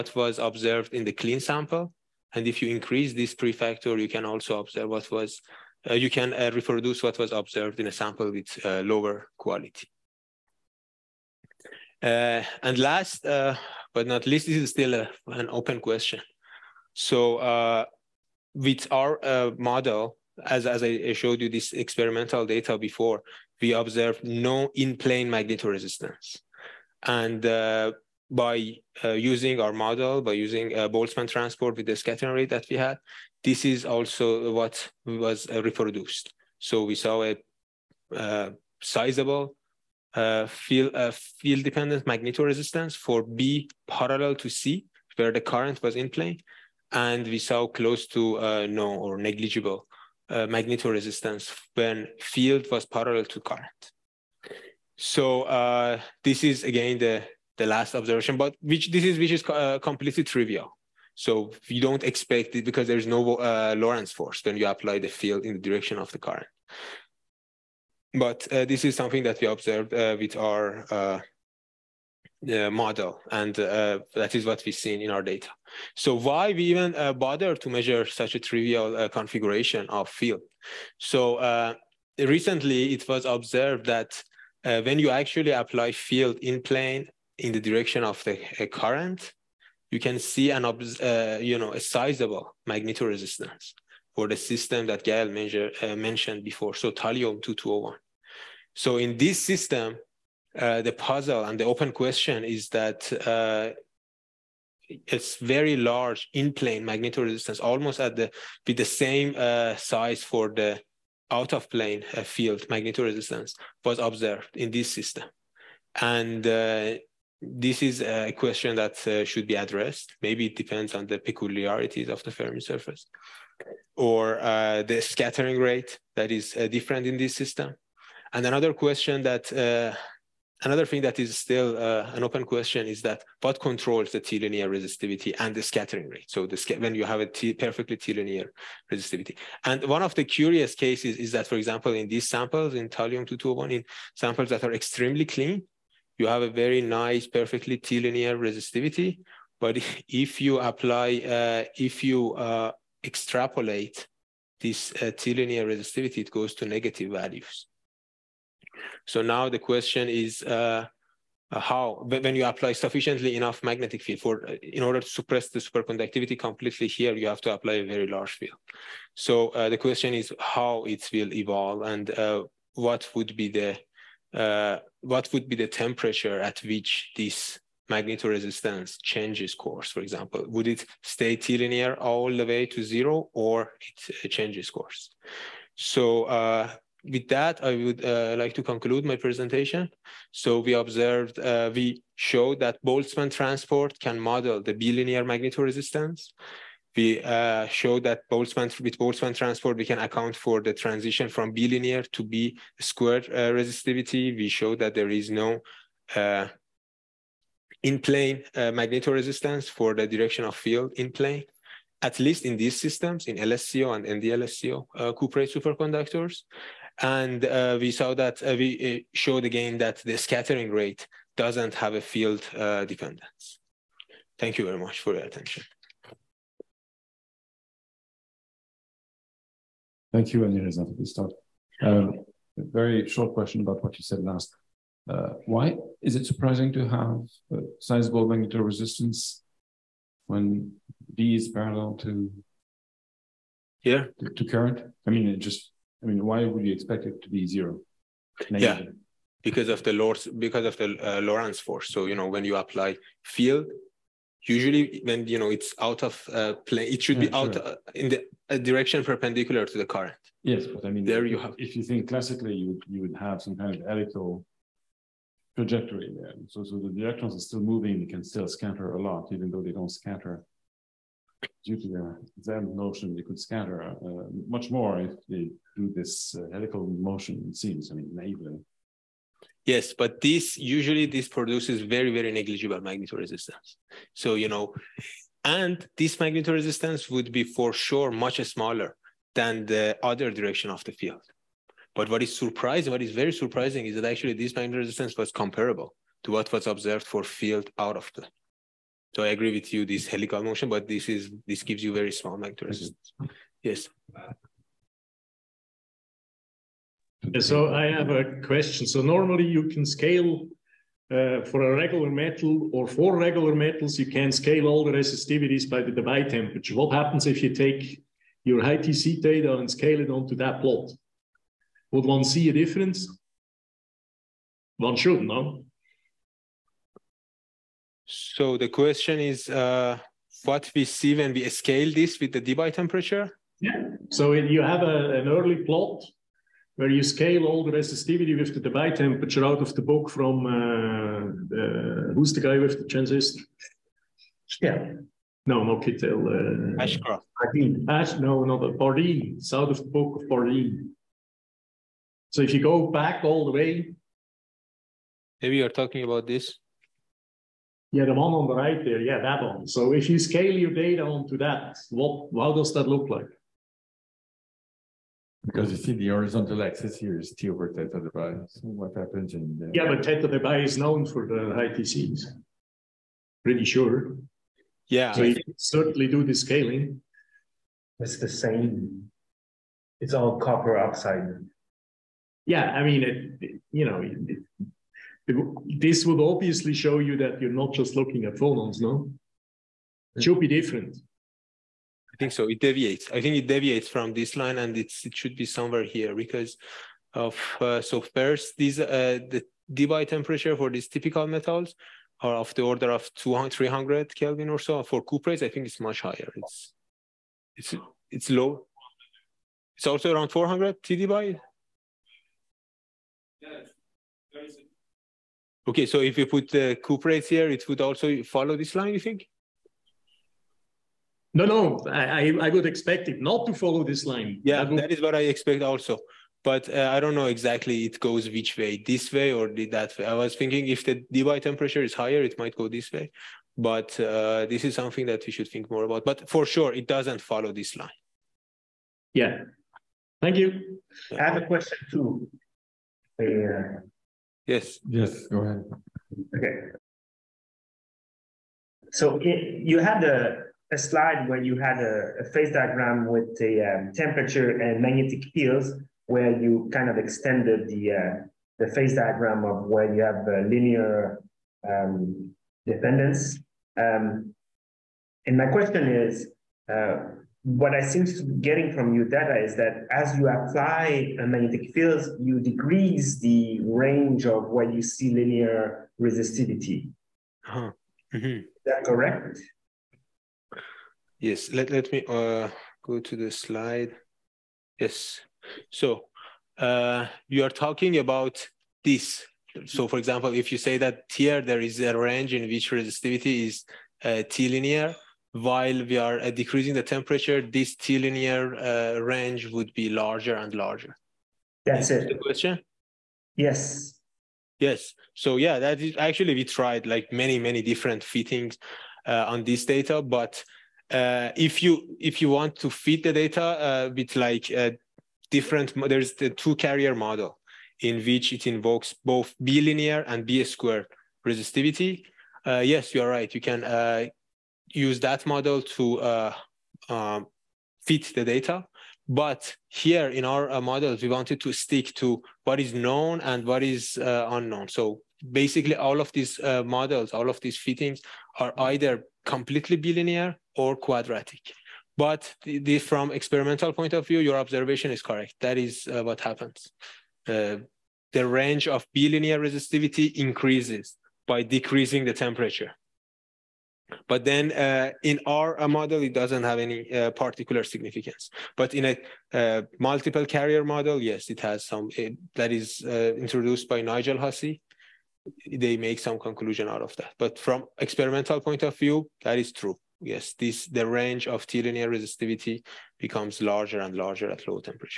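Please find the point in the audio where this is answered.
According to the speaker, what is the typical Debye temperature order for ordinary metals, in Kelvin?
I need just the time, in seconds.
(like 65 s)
403 s.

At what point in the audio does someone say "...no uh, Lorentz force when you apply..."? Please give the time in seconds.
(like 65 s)
63 s.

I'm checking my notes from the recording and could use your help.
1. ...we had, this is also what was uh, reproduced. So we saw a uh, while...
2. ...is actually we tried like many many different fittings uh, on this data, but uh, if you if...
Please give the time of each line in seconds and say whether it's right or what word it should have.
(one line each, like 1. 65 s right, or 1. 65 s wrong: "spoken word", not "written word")
1. 32 s wrong: "sizable", not "while"
2. 505 s right.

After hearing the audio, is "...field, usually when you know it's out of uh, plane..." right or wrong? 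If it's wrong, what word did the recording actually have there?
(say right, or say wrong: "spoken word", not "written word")
right.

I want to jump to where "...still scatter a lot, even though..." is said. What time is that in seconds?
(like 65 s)
268 s.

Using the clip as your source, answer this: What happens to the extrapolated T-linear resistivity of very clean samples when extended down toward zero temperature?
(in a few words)
Goes to negative values.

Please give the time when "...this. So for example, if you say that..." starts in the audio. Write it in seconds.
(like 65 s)
488 s.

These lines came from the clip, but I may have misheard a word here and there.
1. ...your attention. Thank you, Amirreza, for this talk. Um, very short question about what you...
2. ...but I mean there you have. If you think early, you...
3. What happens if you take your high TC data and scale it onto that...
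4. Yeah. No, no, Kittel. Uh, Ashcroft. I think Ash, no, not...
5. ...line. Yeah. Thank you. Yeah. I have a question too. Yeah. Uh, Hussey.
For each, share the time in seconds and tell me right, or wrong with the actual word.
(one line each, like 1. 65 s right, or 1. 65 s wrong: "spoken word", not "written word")
1. 225 s right
2. 260 s wrong: "classically", not "early"
3. 316 s right
4. 344 s right
5. 437 s wrong: "Yes", not "Hussey".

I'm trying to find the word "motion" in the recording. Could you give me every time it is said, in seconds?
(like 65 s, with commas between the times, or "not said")
276 s, 300 s.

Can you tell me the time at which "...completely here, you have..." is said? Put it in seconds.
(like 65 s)
166 s.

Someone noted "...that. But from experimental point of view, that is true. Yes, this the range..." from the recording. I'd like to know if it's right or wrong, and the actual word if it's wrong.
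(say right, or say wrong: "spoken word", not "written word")
right.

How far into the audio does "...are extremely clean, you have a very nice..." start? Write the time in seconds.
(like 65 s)
144 s.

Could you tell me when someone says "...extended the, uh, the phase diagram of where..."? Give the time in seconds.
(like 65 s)
456 s.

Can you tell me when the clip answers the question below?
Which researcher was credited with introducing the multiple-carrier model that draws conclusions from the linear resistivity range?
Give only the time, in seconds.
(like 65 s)
563 s.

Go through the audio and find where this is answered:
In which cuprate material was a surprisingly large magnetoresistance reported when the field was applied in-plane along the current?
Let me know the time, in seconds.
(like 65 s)
96 s.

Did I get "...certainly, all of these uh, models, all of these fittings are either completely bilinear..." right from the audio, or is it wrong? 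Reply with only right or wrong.
wrong.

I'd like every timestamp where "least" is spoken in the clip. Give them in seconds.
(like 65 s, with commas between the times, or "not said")
14 s, 212 s.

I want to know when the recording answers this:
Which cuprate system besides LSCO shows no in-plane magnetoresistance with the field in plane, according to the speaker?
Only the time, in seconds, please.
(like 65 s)
214 s.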